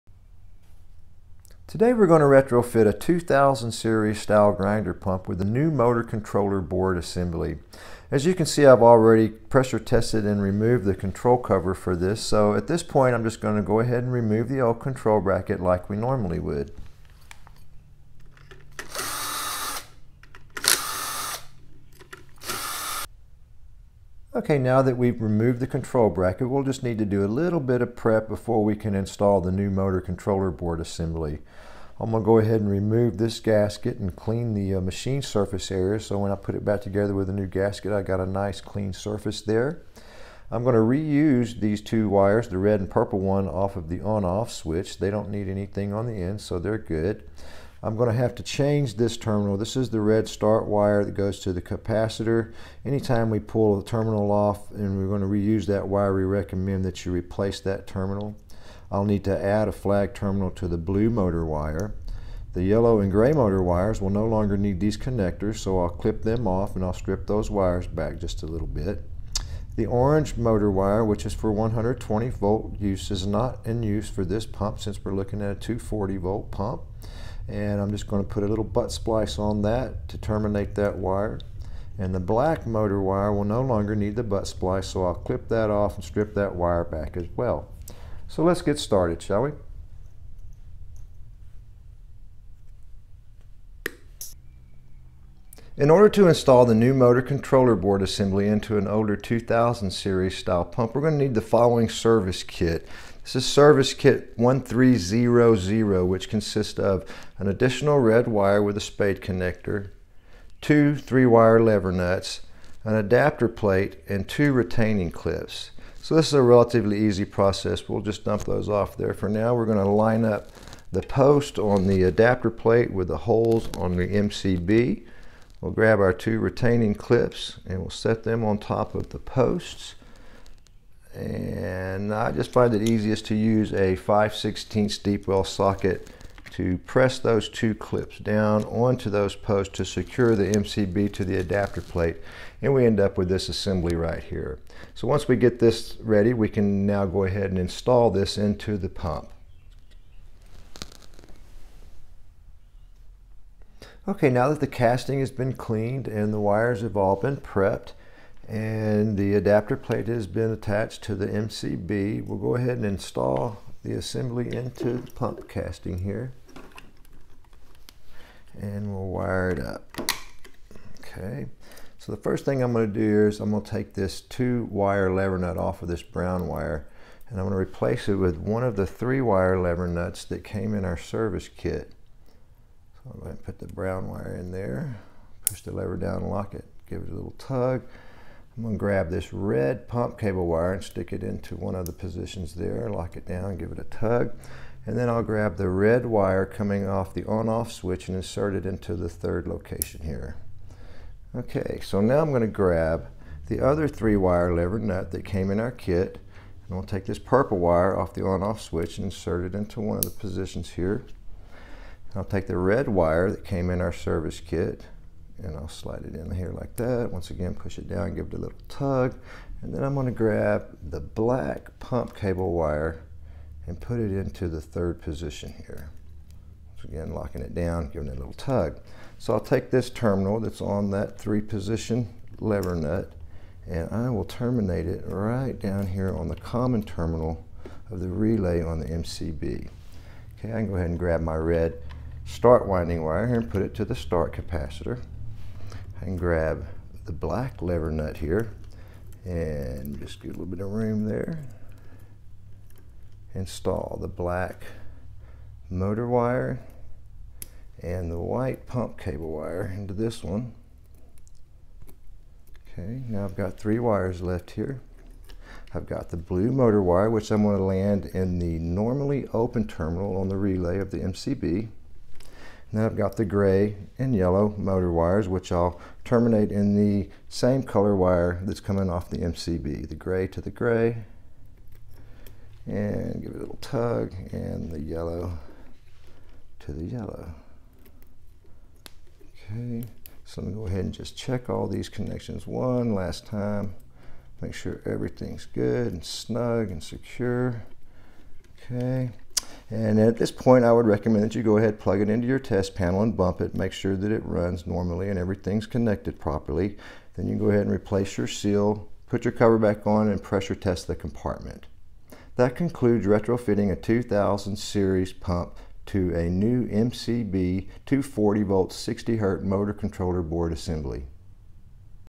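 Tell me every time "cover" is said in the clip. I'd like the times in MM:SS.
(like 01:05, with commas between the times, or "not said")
00:11, 05:09.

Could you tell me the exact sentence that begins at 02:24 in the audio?
So once we get this ready we can now go ahead and install this into the pump.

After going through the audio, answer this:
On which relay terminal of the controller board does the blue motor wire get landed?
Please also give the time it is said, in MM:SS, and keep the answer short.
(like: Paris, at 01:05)
Normally open terminal, at 04:28.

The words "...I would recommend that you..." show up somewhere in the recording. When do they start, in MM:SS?
05:00.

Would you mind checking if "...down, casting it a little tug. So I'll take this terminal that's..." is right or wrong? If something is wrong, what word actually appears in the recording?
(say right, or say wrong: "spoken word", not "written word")
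wrong: "giving", not "casting".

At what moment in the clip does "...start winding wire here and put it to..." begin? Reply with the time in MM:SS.
04:02.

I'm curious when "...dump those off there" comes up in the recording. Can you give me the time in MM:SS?
01:58.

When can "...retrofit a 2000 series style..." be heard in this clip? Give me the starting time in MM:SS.
00:02.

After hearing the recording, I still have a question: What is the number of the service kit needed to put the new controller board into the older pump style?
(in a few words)
1300.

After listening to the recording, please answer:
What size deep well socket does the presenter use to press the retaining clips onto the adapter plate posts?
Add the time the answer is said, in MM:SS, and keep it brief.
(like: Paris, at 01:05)
5/16, at 02:13.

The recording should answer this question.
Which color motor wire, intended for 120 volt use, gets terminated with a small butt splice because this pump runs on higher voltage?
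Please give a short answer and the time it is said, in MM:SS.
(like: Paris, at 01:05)
Orange, at 01:09.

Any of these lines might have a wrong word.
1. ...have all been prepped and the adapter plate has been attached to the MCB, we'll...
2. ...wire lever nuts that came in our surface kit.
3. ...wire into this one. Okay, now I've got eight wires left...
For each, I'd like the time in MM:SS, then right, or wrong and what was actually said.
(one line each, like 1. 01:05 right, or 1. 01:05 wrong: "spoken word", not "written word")
1. 02:36 right
2. 02:59 wrong: "service", not "surface"
3. 04:19 wrong: "three", not "eight".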